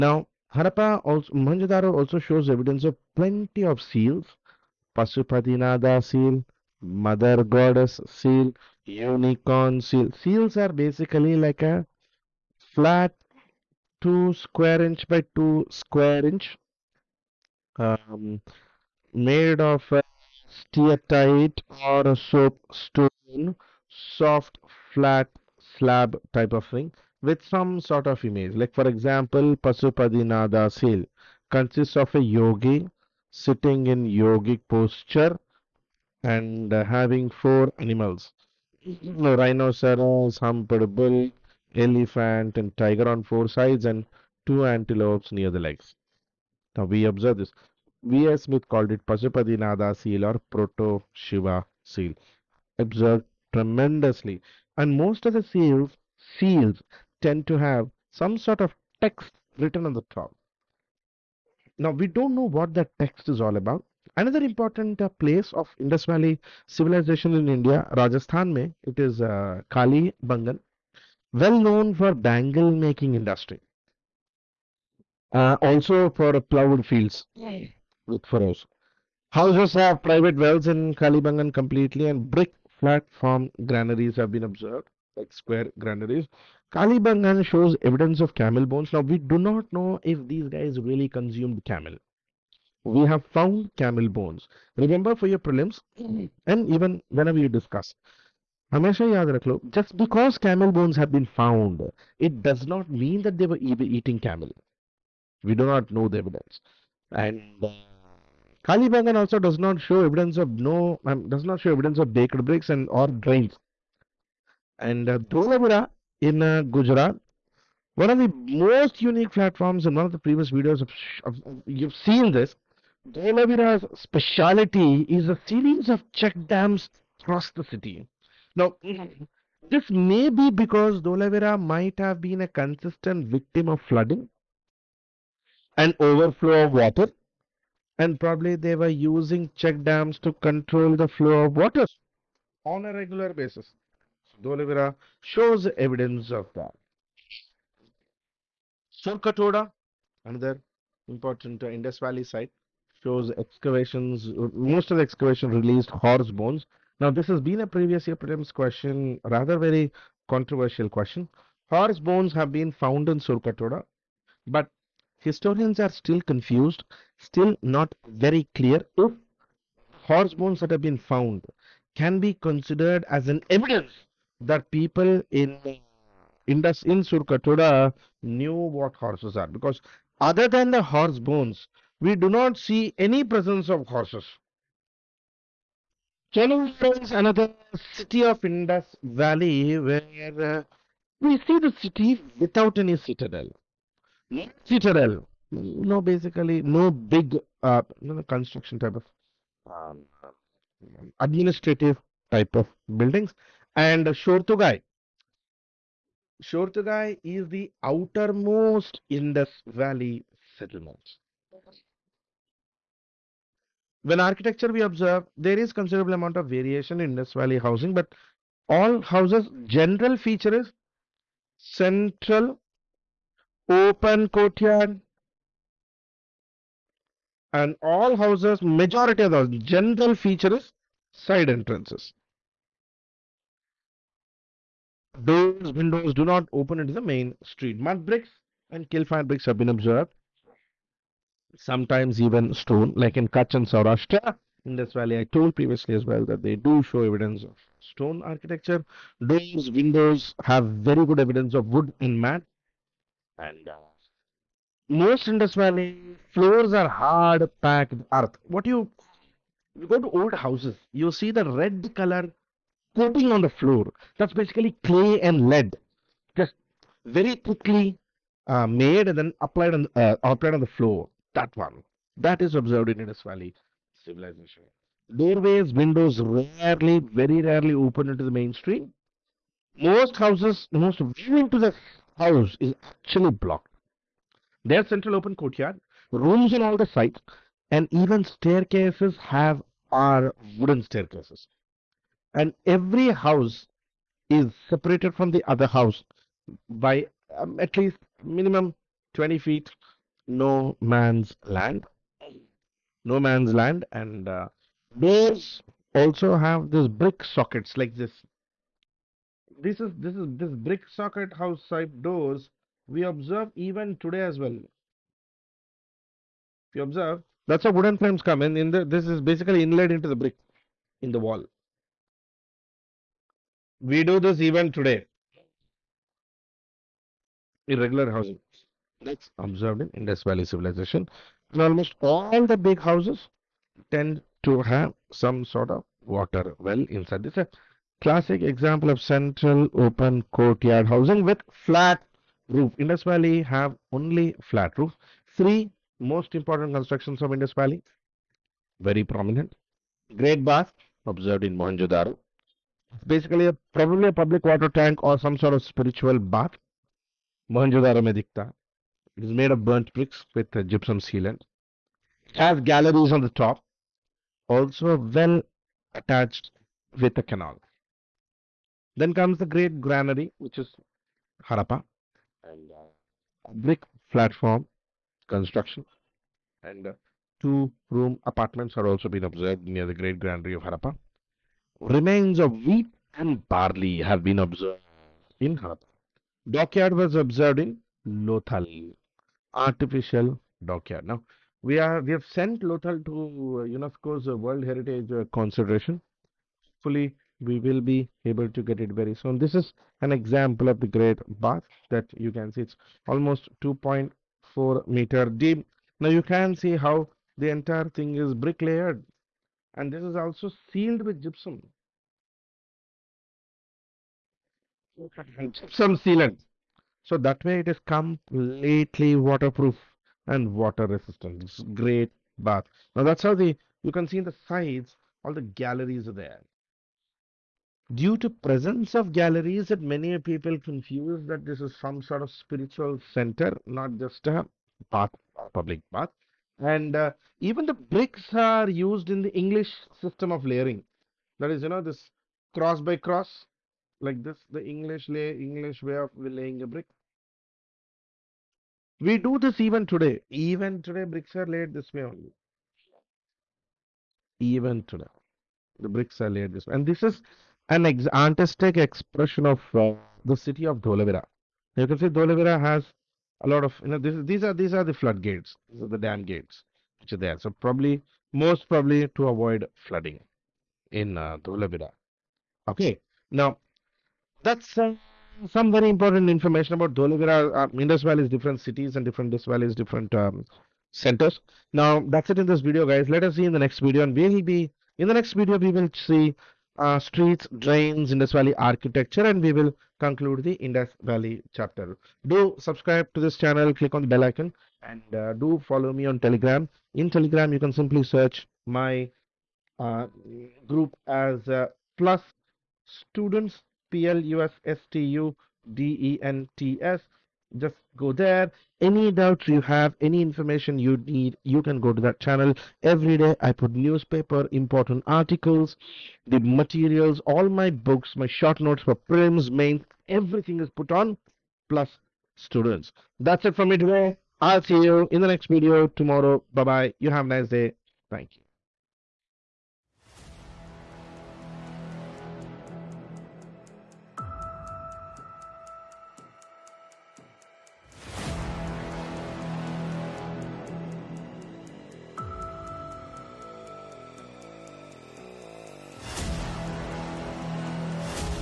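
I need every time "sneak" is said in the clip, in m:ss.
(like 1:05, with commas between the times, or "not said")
not said.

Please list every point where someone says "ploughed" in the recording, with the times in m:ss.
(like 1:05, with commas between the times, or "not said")
1:16.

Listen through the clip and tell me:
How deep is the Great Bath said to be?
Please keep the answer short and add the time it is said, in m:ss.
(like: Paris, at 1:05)
2.4 meters, at 6:43.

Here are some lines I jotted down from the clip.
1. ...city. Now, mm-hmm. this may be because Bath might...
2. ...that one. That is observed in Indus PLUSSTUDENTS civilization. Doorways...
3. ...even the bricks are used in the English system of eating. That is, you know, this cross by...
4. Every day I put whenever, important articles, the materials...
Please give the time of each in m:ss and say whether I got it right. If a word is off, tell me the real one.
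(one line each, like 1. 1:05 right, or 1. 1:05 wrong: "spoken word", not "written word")
1. 2:07 wrong: "Dholavira", not "Bath"
2. 4:31 wrong: "Valley", not "PLUSSTUDENTS"
3. 7:17 wrong: "layering", not "eating"
4. 8:32 wrong: "newspaper", not "whenever".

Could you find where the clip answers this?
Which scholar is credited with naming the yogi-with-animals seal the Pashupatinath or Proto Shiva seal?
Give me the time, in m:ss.
0:48.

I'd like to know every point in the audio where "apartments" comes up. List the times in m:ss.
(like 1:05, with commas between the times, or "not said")
6:18.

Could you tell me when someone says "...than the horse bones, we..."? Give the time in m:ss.
3:00.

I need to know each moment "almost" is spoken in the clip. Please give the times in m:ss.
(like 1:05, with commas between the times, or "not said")
5:31, 6:43.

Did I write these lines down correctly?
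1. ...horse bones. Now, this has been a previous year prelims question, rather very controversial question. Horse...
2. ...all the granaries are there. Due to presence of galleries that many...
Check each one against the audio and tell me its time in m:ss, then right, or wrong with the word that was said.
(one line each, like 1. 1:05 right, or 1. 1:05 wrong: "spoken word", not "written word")
1. 2:35 right
2. 7:05 wrong: "galleries", not "granaries".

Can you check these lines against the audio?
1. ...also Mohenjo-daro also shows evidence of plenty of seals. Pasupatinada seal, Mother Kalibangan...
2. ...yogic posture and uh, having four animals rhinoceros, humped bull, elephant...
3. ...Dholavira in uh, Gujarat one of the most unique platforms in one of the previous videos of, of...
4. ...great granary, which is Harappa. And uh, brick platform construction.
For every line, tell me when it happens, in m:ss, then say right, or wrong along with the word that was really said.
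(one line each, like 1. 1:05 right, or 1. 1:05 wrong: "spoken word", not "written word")
1. 0:01 wrong: "Goddess", not "Kalibangan"
2. 0:34 right
3. 1:55 right
4. 6:09 right.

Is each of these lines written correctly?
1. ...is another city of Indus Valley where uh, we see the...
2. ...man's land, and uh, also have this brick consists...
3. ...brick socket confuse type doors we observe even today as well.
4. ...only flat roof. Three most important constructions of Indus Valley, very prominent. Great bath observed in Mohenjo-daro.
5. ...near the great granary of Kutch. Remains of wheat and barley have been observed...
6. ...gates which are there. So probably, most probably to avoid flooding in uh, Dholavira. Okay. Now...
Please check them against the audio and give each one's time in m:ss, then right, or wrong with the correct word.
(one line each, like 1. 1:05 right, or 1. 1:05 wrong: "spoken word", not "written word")
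1. 3:07 right
2. 5:03 wrong: "sockets", not "consists"
3. 5:10 wrong: "house", not "confuse"
4. 5:43 right
5. 6:19 wrong: "Harappa", not "Kutch"
6. 7:46 right.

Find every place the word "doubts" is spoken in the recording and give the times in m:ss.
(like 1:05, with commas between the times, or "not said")
8:29.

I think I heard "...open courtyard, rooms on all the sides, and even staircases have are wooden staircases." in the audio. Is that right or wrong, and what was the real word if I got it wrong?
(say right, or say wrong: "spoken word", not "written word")
right.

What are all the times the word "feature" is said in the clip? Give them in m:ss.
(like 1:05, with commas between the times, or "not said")
3:40, 3:50.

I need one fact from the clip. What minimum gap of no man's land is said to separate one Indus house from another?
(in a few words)
20 feet.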